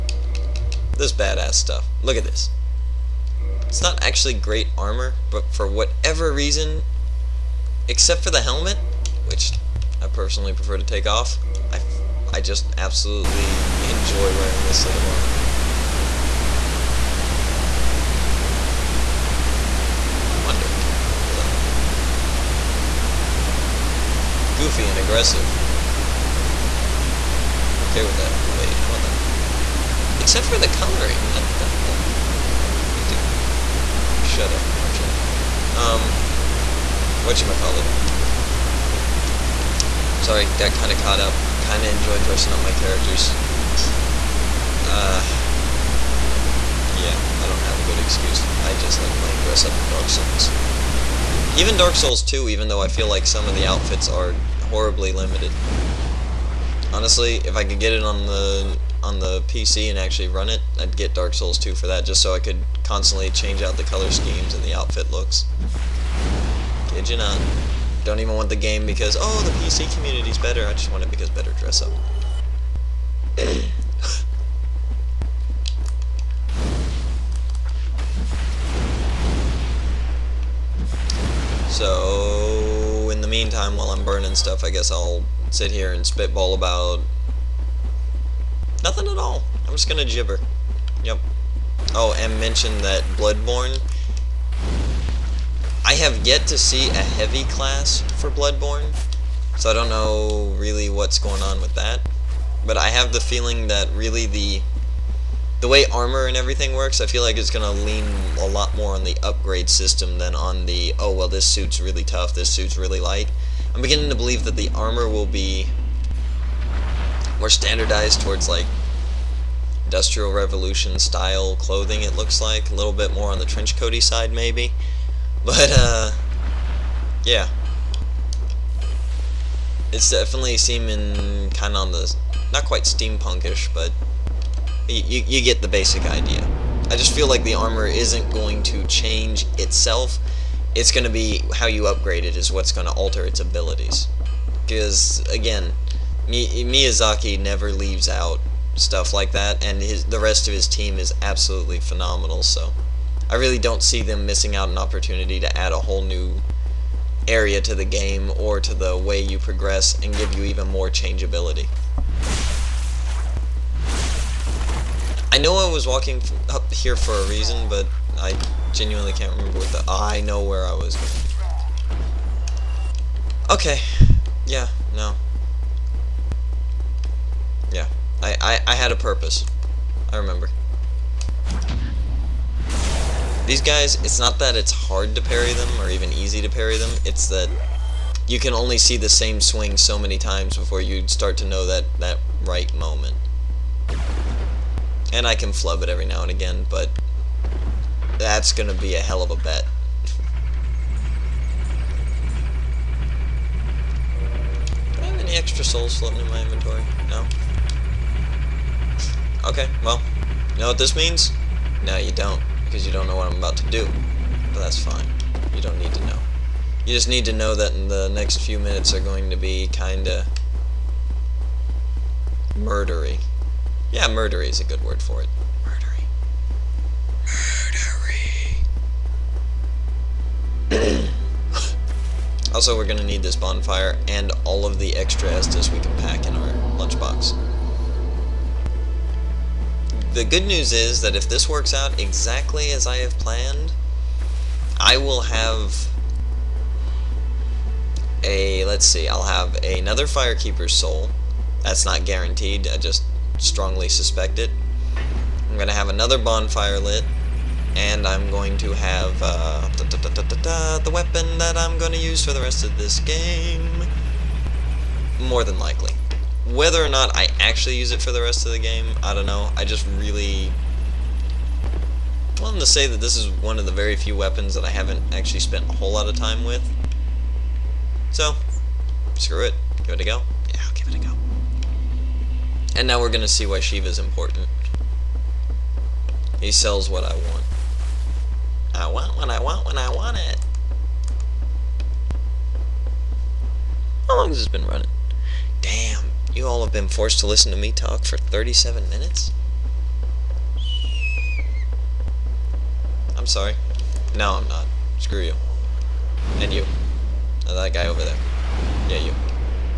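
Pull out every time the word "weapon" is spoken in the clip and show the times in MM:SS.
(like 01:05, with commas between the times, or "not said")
04:20, 04:34.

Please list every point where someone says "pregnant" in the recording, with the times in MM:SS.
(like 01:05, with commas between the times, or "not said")
not said.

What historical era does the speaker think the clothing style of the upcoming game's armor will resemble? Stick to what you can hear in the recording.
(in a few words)
Industrial Revolution.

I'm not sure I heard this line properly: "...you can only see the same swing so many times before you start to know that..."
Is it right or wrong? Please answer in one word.
right.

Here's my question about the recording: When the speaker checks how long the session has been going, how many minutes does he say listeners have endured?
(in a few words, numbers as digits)
37.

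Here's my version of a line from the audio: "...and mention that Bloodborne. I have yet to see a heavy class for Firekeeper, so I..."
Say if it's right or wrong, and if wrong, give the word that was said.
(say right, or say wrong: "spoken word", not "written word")
wrong: "Bloodborne", not "Firekeeper".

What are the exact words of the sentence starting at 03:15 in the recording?
And I can flub it every now and again, but that's going to be a hell of a bet.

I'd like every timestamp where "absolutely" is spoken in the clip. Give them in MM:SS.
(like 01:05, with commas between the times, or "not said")
00:12, 02:31.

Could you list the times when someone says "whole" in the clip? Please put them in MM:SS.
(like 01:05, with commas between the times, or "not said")
02:35, 04:35.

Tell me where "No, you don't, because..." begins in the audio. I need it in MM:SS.
03:31.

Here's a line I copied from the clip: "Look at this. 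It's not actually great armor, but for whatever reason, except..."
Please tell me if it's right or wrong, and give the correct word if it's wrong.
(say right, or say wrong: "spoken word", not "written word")
right.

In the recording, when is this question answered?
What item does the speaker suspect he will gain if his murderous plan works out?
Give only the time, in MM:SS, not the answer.
04:10.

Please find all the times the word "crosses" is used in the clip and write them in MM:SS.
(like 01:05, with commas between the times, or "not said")
not said.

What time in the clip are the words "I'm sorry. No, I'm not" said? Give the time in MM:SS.
05:03.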